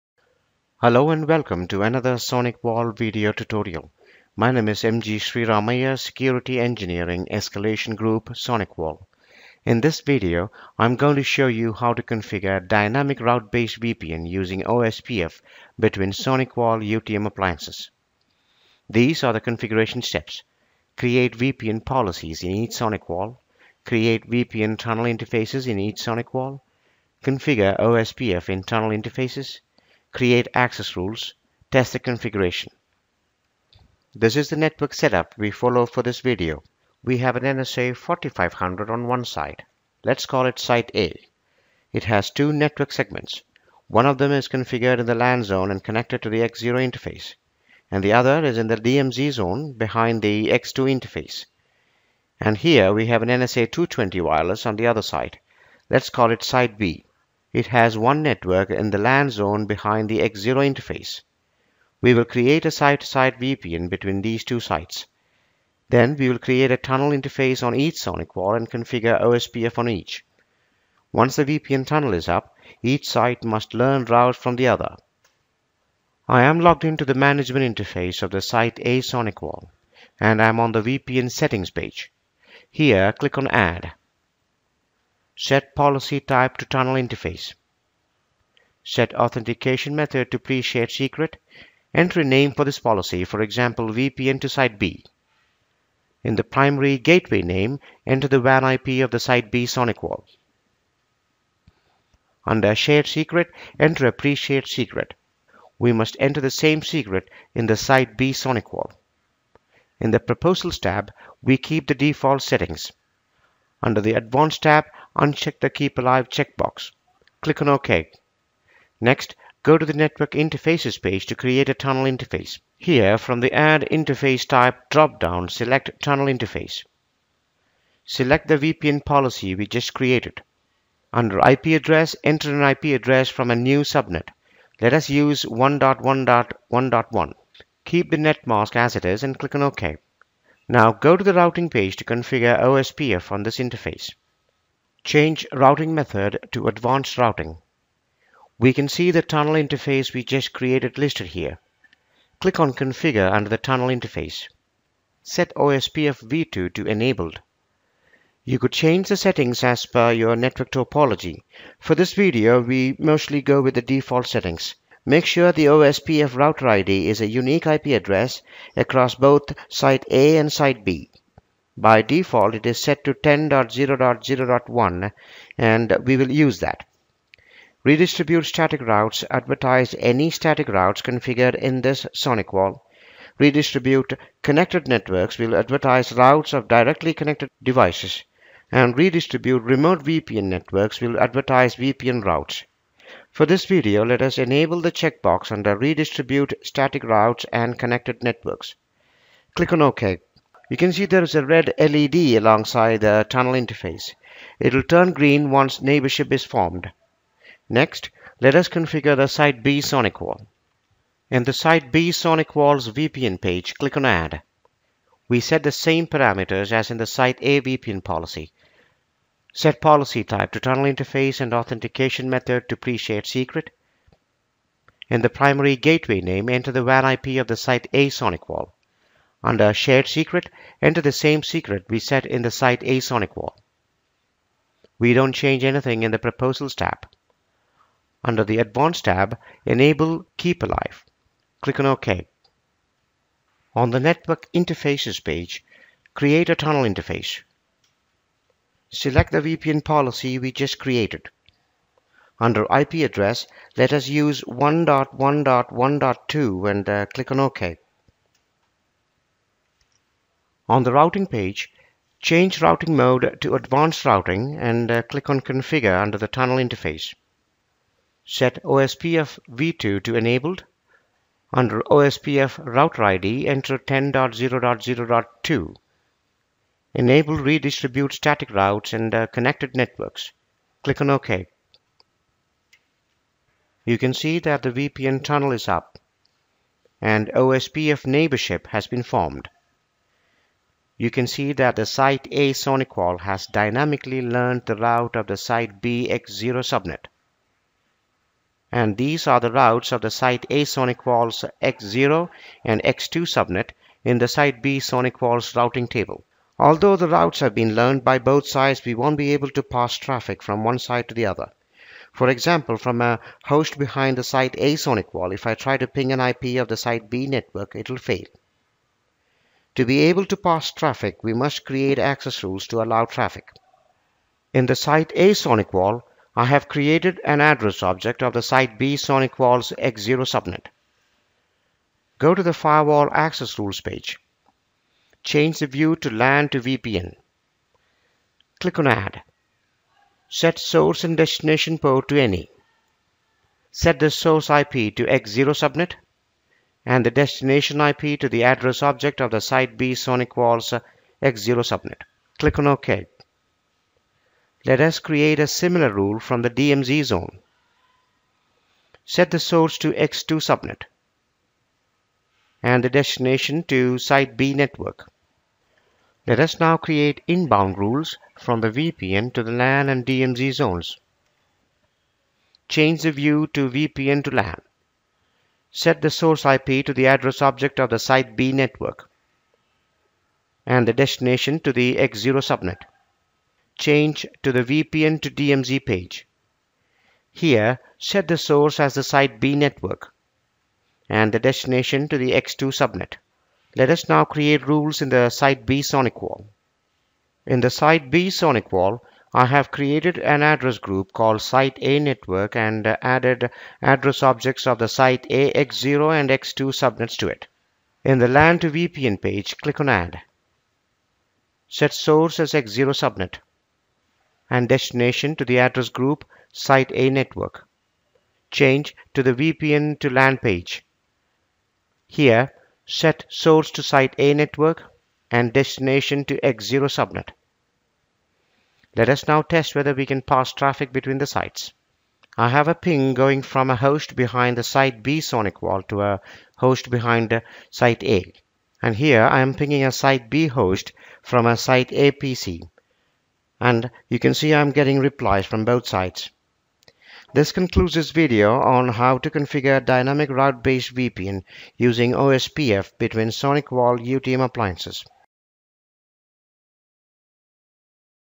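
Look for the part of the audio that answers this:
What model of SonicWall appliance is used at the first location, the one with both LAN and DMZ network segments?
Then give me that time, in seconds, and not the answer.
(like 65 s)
37 s.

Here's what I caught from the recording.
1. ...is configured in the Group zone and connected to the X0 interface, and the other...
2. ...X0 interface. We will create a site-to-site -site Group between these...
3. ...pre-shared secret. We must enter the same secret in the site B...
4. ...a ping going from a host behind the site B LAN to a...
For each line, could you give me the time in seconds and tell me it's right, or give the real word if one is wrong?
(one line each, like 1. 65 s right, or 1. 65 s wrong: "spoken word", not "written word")
1. 44 s wrong: "LAN", not "Group"
2. 60 s wrong: "VPN", not "Group"
3. 104 s right
4. 432 s wrong: "SonicWall", not "LAN".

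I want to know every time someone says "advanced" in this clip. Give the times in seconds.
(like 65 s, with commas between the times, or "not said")
114 s, 146 s, 238 s, 263 s.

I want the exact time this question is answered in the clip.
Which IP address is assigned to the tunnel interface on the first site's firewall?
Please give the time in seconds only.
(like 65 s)
135 s.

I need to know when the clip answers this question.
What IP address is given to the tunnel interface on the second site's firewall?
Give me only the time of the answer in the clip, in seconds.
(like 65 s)
254 s.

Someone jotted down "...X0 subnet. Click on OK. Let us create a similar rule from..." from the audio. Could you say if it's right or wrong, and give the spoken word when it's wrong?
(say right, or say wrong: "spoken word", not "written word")
right.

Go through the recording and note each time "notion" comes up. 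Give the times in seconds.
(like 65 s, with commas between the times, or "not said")
not said.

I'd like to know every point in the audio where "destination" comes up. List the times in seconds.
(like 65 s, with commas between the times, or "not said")
341 s, 347 s, 362 s, 380 s, 391 s, 414 s, 425 s.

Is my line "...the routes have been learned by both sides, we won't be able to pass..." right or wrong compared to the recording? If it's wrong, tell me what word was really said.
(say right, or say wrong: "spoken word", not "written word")
right.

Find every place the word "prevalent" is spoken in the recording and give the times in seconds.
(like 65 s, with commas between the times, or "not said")
not said.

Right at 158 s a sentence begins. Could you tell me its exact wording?
You could change the settings as per your network topology.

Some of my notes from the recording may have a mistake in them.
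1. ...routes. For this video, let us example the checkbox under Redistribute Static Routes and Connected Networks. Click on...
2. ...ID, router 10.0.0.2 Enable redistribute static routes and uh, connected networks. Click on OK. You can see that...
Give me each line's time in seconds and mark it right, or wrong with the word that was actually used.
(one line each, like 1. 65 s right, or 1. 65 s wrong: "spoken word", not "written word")
1. 192 s wrong: "enable", not "example"
2. 273 s wrong: "enter", not "router".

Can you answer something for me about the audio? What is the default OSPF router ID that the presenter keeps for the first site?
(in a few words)
10.0.0.1.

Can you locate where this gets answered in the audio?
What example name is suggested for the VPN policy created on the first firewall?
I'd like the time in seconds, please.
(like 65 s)
93 s.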